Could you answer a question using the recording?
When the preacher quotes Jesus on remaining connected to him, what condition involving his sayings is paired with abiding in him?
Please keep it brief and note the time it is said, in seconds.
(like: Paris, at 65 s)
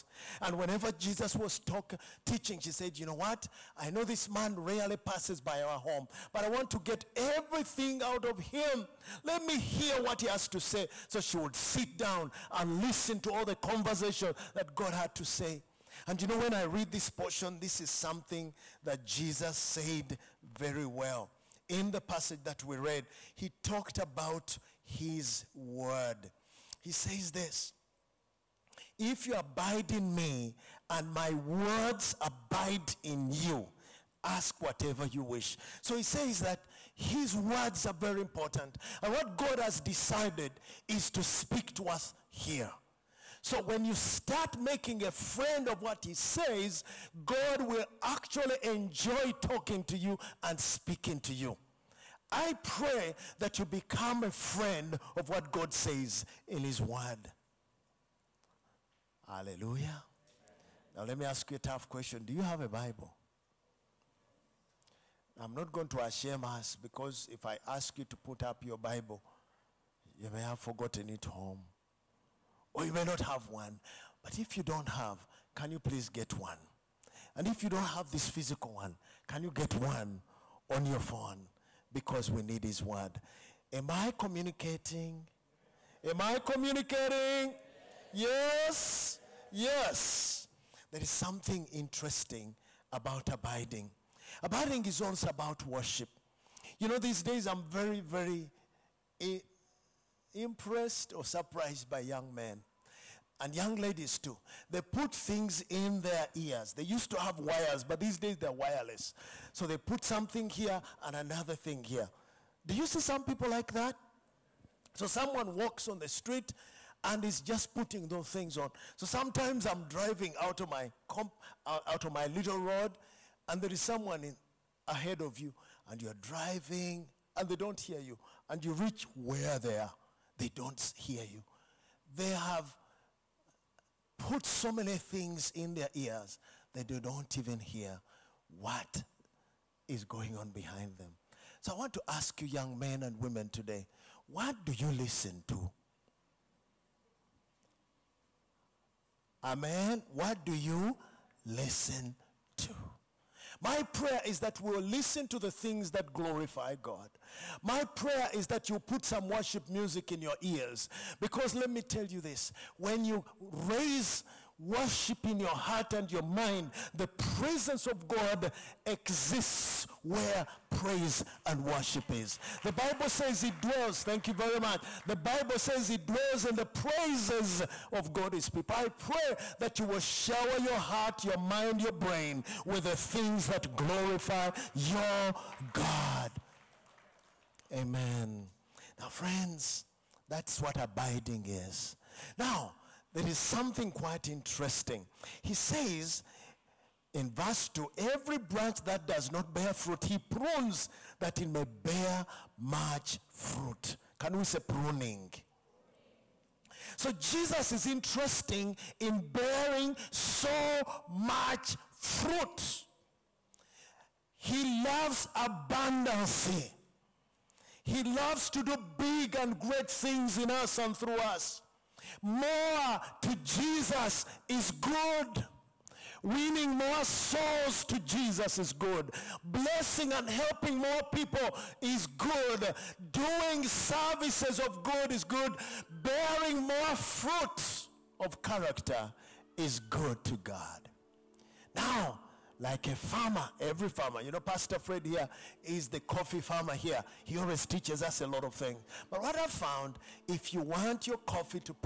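my words abide in you, at 31 s.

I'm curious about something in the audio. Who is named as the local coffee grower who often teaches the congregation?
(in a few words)
Pastor Fred.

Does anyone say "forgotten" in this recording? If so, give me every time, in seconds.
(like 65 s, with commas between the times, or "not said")
70 s.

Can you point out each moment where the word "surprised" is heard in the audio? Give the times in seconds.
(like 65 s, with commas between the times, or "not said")
101 s.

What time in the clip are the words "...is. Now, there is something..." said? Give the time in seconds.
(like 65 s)
191 s.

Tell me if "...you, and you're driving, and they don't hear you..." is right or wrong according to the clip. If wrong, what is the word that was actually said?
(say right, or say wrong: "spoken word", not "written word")
right.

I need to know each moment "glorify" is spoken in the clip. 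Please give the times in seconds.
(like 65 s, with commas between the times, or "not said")
156 s, 183 s.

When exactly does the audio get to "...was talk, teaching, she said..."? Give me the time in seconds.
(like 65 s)
1 s.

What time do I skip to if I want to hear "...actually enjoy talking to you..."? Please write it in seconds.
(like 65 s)
48 s.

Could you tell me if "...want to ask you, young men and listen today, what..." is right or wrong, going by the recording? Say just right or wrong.
wrong.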